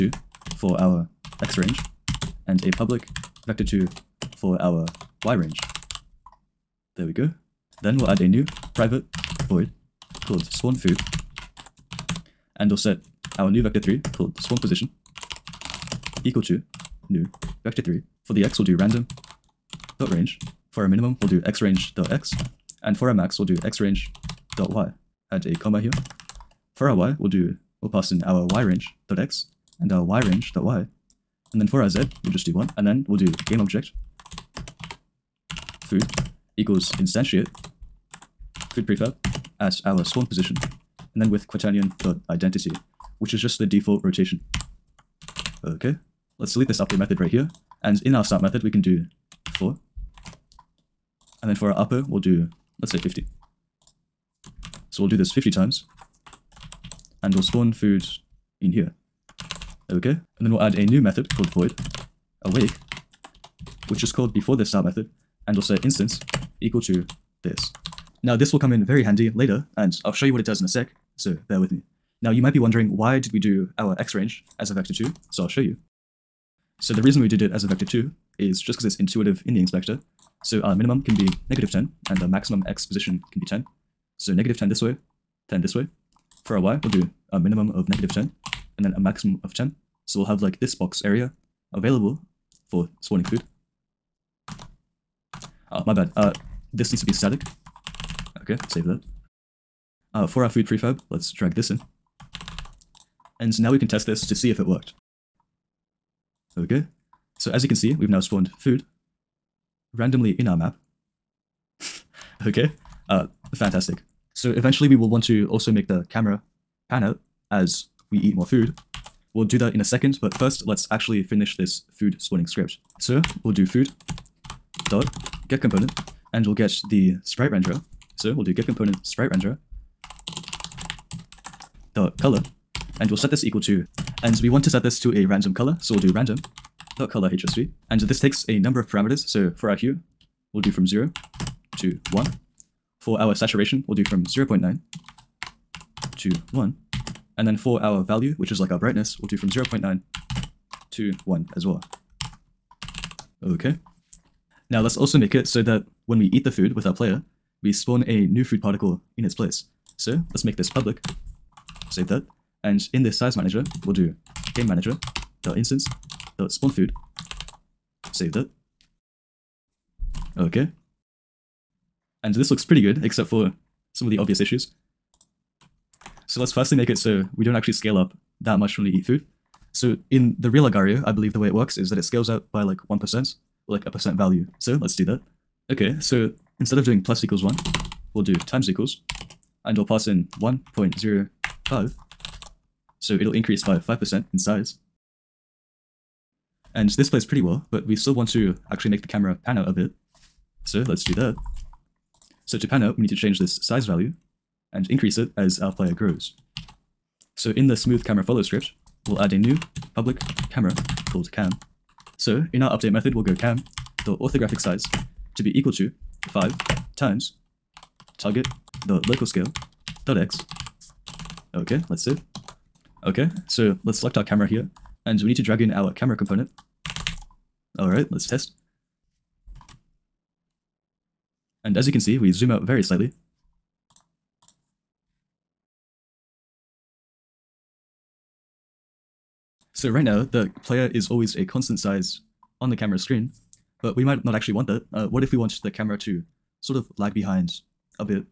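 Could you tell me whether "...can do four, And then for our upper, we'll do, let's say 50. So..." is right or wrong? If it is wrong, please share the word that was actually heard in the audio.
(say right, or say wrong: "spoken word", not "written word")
right.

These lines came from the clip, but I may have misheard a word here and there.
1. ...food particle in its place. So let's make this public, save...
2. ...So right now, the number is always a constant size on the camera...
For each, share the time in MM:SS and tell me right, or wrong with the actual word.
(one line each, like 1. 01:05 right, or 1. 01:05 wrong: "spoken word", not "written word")
1. 02:38 right
2. 03:59 wrong: "player", not "number".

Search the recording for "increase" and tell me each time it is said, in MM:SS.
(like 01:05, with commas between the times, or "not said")
03:13, 03:24.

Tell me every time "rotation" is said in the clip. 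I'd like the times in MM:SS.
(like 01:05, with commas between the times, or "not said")
00:44.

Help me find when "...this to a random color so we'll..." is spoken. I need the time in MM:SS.
02:14.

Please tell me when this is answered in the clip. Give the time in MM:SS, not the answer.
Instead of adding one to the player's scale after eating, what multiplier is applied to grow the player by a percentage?
03:10.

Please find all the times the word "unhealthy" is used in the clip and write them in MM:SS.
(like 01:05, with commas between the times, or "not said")
not said.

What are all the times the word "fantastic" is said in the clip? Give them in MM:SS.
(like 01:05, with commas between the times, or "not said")
01:53.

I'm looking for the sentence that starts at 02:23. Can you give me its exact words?
For our saturation, we'll do from 0.9 to 1.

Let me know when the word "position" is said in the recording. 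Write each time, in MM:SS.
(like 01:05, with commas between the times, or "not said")
00:14, 00:40, 01:22.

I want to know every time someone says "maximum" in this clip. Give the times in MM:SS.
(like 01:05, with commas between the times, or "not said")
01:22, 01:28.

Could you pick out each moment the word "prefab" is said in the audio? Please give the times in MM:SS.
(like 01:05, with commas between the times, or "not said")
00:38, 01:40.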